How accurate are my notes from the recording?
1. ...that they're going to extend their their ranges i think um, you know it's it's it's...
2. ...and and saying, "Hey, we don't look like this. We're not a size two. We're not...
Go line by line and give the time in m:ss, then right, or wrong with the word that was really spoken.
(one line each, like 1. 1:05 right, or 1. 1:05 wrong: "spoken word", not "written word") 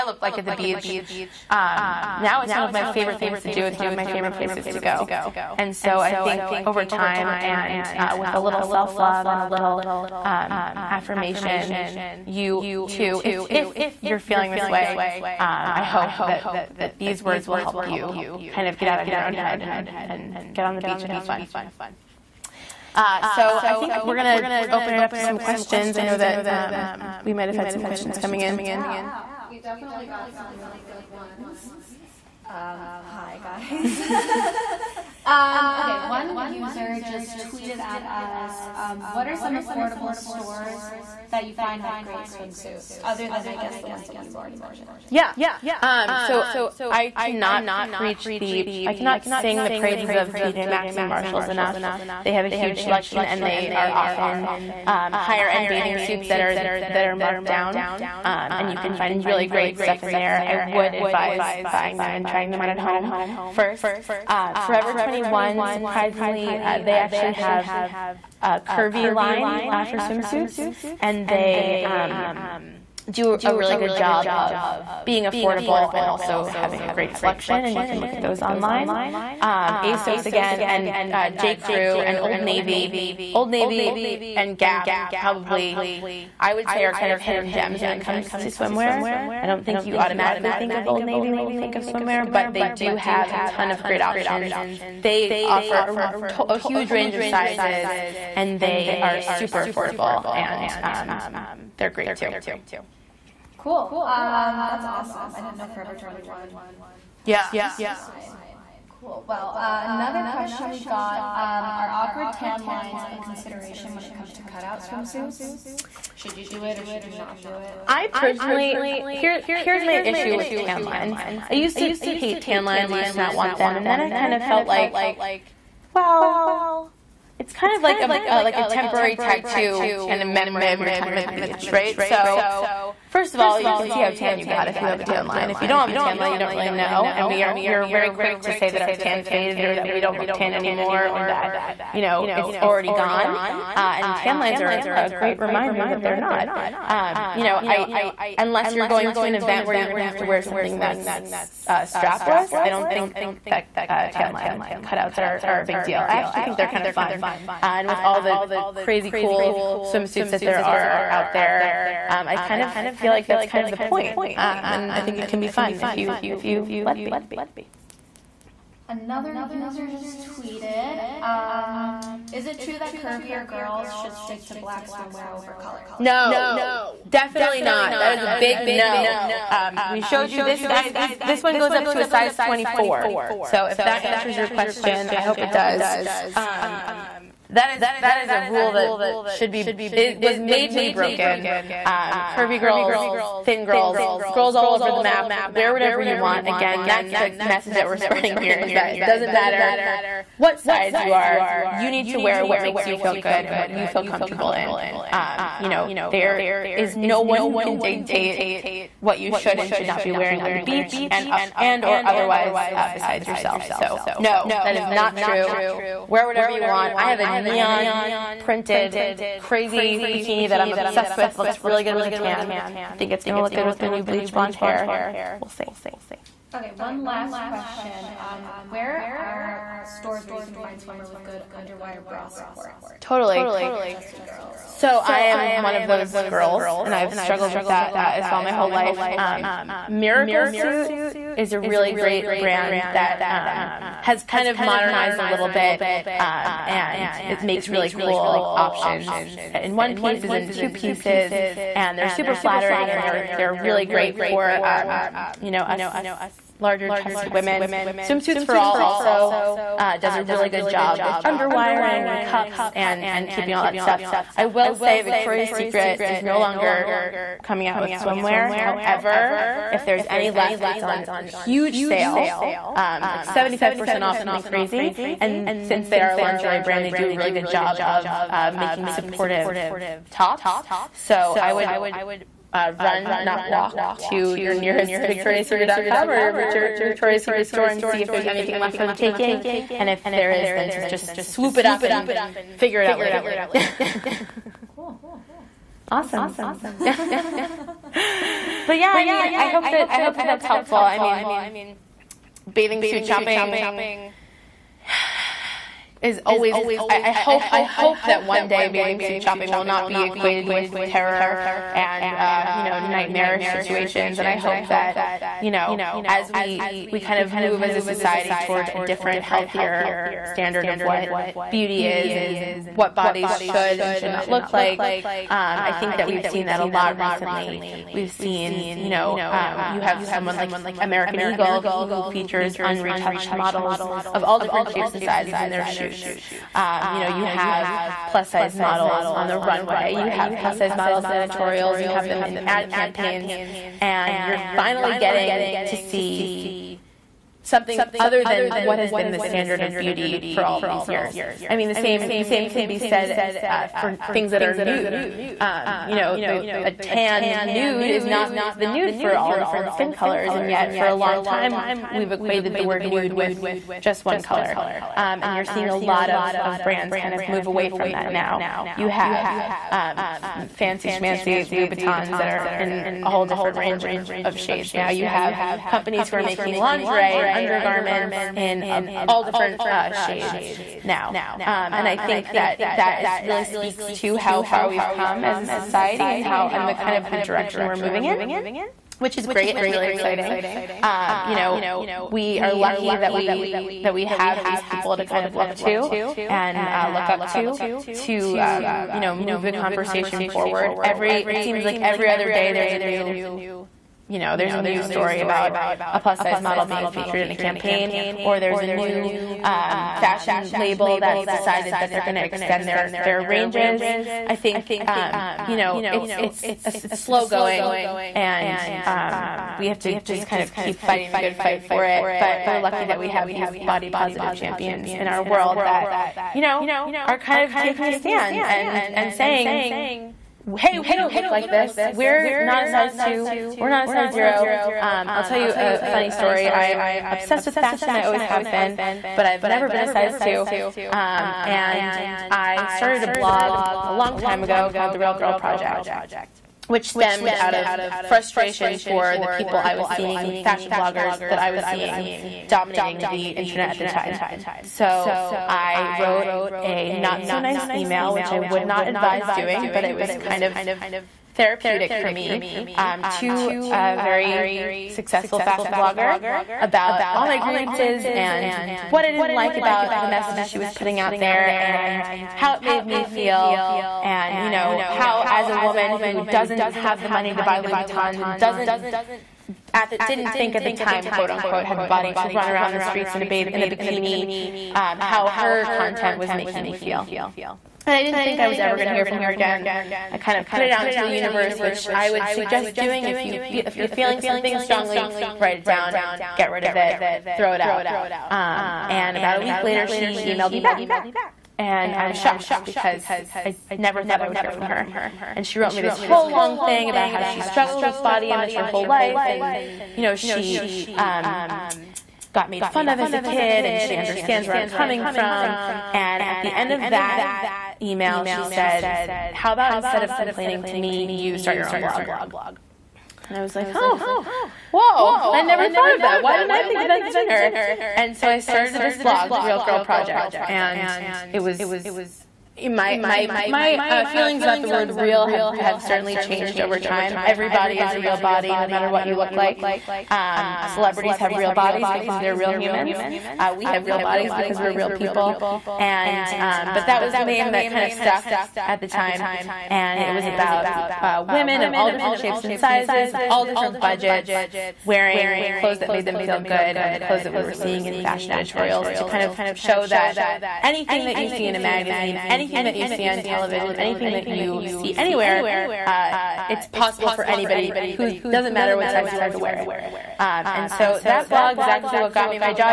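1. 6:51 right
2. 7:08 right.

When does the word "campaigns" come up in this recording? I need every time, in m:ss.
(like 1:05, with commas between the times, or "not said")
5:42, 6:47.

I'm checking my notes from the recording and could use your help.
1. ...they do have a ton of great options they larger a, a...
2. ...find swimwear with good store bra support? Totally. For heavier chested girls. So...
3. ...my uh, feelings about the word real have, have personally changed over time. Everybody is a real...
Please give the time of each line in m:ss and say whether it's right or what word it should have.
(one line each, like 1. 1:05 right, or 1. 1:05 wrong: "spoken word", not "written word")
1. 1:32 wrong: "offer", not "larger"
2. 3:50 wrong: "underwire", not "store"
3. 8:53 wrong: "certainly", not "personally".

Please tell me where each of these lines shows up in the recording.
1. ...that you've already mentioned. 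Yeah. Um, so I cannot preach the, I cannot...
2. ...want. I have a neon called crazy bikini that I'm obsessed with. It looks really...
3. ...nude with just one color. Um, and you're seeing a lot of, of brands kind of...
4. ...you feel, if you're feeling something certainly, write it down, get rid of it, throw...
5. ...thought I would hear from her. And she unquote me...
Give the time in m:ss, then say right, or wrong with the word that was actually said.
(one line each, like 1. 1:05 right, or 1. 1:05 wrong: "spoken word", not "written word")
1. 0:44 right
2. 3:36 wrong: "printed", not "called"
3. 6:02 right
4. 8:13 wrong: "strongly", not "certainly"
5. 8:24 wrong: "wrote", not "unquote".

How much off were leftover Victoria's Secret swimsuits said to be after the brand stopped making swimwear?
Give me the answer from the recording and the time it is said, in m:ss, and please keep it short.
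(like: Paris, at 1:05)
75%, at 4:33.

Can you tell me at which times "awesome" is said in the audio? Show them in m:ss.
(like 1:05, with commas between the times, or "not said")
1:44, 4:55.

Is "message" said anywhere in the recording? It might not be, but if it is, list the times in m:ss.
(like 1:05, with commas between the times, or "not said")
3:17, 7:50.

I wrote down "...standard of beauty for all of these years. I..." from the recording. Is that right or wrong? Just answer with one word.
right.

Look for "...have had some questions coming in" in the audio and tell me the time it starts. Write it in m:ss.
0:27.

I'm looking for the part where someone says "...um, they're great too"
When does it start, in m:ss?
1:40.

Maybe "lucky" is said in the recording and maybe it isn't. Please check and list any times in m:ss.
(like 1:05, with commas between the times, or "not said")
6:32, 7:02.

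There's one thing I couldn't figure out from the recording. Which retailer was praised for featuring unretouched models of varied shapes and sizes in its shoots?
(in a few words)
American Eagle.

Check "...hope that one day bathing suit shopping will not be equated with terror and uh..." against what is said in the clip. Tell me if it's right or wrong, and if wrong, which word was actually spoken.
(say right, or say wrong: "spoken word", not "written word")
right.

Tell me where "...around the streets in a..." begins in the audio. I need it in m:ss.
8:02.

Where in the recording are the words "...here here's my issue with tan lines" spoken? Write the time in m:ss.
1:59.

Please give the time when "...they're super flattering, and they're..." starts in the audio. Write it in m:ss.
4:11.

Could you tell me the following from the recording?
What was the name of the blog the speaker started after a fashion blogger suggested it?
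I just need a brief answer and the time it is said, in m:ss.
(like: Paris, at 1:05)
The Real Girl Project, at 7:24.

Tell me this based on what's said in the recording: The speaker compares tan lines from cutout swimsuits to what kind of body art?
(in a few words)
temporary tattoo.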